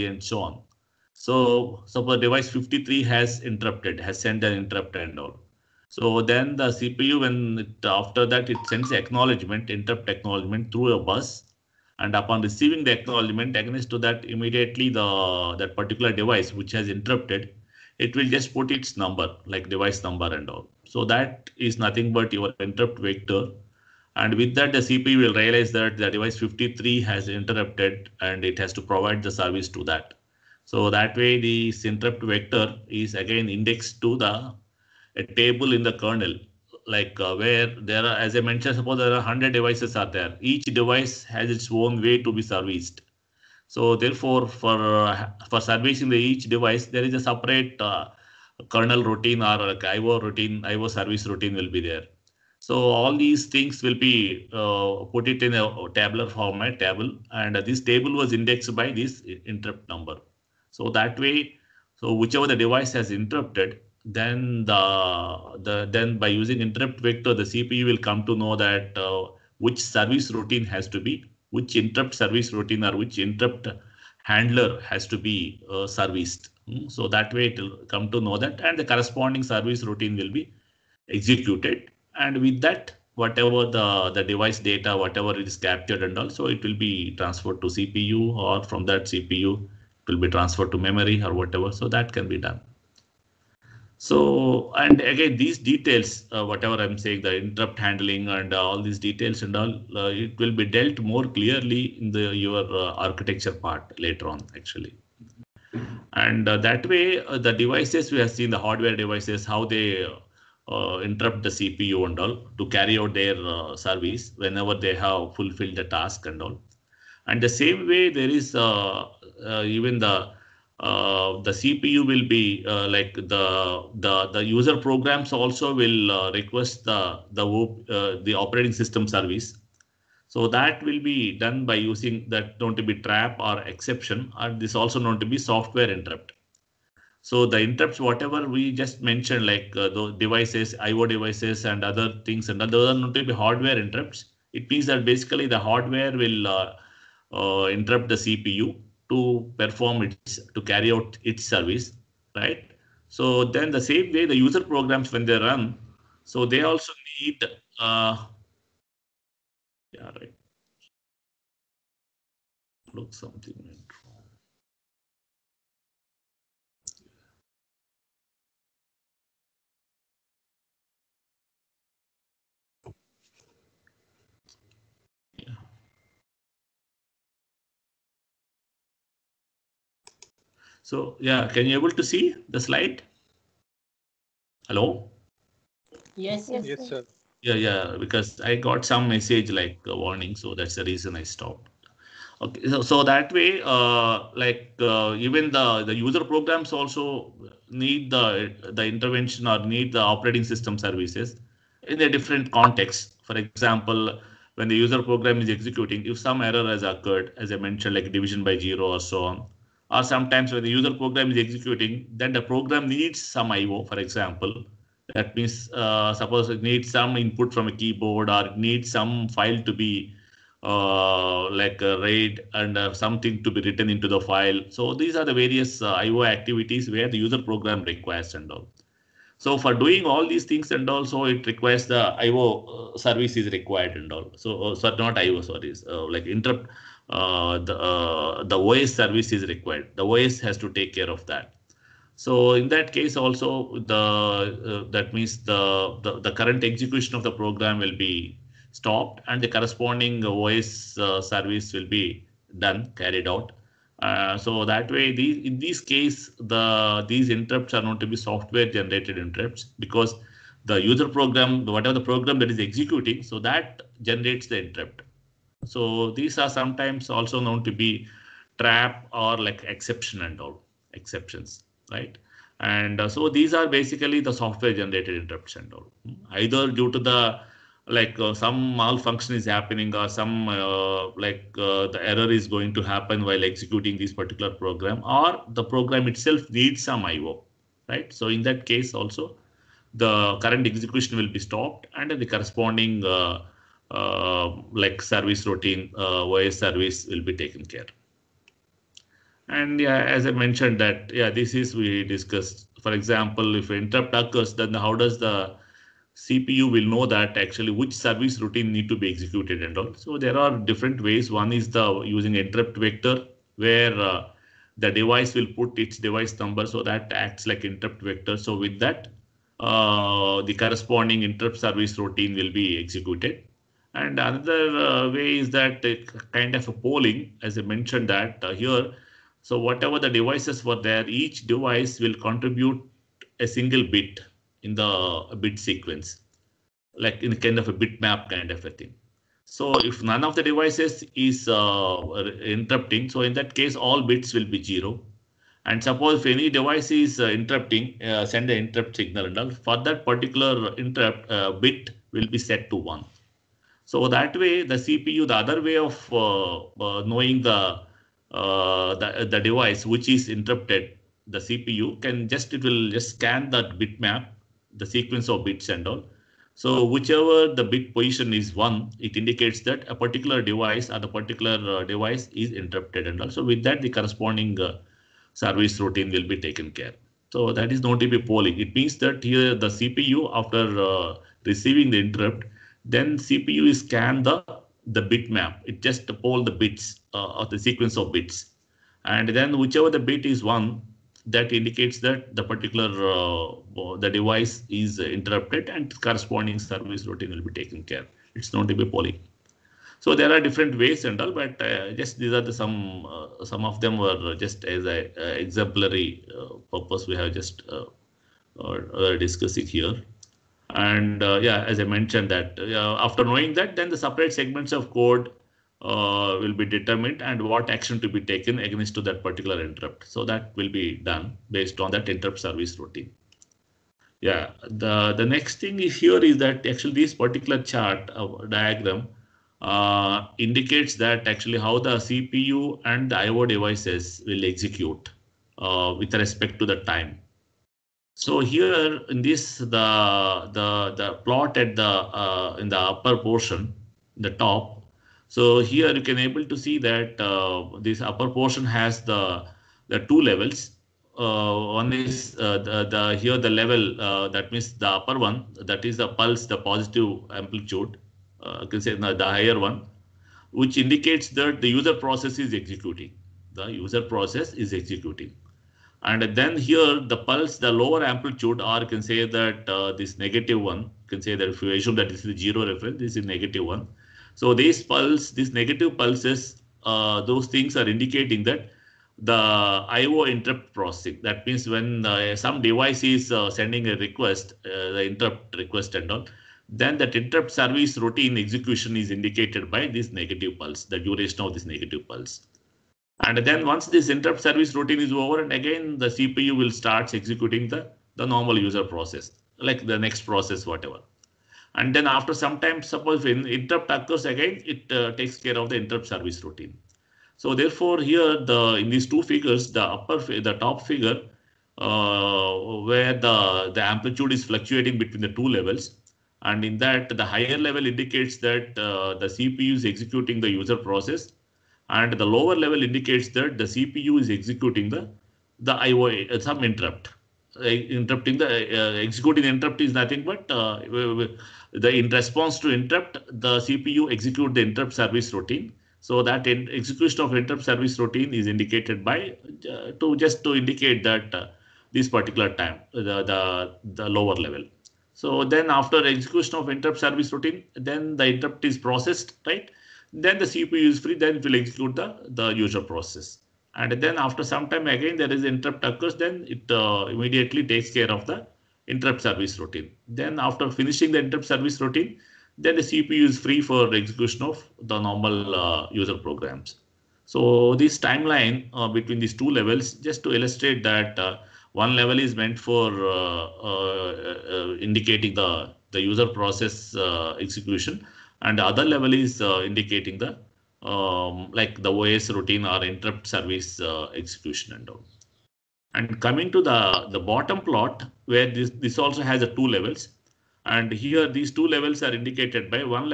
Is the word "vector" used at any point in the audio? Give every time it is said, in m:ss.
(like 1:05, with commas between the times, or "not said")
0:22, 0:32, 1:06, 5:12, 5:18.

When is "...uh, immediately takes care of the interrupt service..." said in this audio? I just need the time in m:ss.
9:16.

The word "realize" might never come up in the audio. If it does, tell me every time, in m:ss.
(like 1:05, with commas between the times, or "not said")
0:25.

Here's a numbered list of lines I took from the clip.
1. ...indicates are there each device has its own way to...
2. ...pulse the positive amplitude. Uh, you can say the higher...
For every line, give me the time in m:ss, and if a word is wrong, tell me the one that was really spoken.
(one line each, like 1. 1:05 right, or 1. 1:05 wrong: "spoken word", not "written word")
1. 0:39 wrong: "devices", not "indicates"
2. 7:36 right.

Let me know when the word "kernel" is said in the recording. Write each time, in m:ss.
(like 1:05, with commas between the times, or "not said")
0:35, 0:48.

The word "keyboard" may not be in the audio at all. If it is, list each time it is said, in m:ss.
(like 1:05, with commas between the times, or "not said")
3:37.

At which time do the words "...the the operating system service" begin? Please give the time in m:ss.
2:07.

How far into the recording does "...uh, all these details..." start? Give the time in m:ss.
1:38.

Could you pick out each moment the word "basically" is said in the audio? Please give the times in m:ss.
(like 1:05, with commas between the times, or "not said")
2:25, 4:33.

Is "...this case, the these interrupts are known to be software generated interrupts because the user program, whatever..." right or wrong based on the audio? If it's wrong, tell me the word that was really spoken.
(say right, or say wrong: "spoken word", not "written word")
right.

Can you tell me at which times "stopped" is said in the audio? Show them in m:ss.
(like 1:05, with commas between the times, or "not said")
3:11, 4:08, 4:51.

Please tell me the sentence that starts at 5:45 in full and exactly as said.
And suppose if any device is uh, interrupting, uh, send the interrupt signal and all.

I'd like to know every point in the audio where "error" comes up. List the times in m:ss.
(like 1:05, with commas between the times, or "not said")
3:26, 4:42.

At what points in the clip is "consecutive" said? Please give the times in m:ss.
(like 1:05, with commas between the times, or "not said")
not said.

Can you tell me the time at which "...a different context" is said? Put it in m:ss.
3:21.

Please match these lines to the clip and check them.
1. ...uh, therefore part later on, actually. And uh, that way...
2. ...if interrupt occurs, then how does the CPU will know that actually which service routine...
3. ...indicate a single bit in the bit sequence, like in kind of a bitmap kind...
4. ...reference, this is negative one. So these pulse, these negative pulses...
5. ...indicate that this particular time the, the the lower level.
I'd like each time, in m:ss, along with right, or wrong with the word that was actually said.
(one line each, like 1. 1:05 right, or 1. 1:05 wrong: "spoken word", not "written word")
1. 1:42 wrong: "architecture", not "therefore"
2. 5:03 right
3. 5:32 wrong: "contribute", not "indicate"
4. 7:52 right
5. 9:00 right.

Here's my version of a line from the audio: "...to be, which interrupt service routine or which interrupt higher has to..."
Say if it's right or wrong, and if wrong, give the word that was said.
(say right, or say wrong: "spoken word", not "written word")
wrong: "handler", not "higher".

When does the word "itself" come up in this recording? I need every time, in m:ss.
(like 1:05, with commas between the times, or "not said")
4:46.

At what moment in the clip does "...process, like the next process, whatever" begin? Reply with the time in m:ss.
8:18.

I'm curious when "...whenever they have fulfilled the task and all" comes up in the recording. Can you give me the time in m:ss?
1:54.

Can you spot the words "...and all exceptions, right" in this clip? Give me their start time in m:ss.
4:30.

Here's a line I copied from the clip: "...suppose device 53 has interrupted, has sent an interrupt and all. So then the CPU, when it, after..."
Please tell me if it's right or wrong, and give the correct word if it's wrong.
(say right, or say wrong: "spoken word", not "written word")
right.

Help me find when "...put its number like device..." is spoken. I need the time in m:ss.
0:18.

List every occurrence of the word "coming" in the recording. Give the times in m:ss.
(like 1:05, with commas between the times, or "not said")
9:46.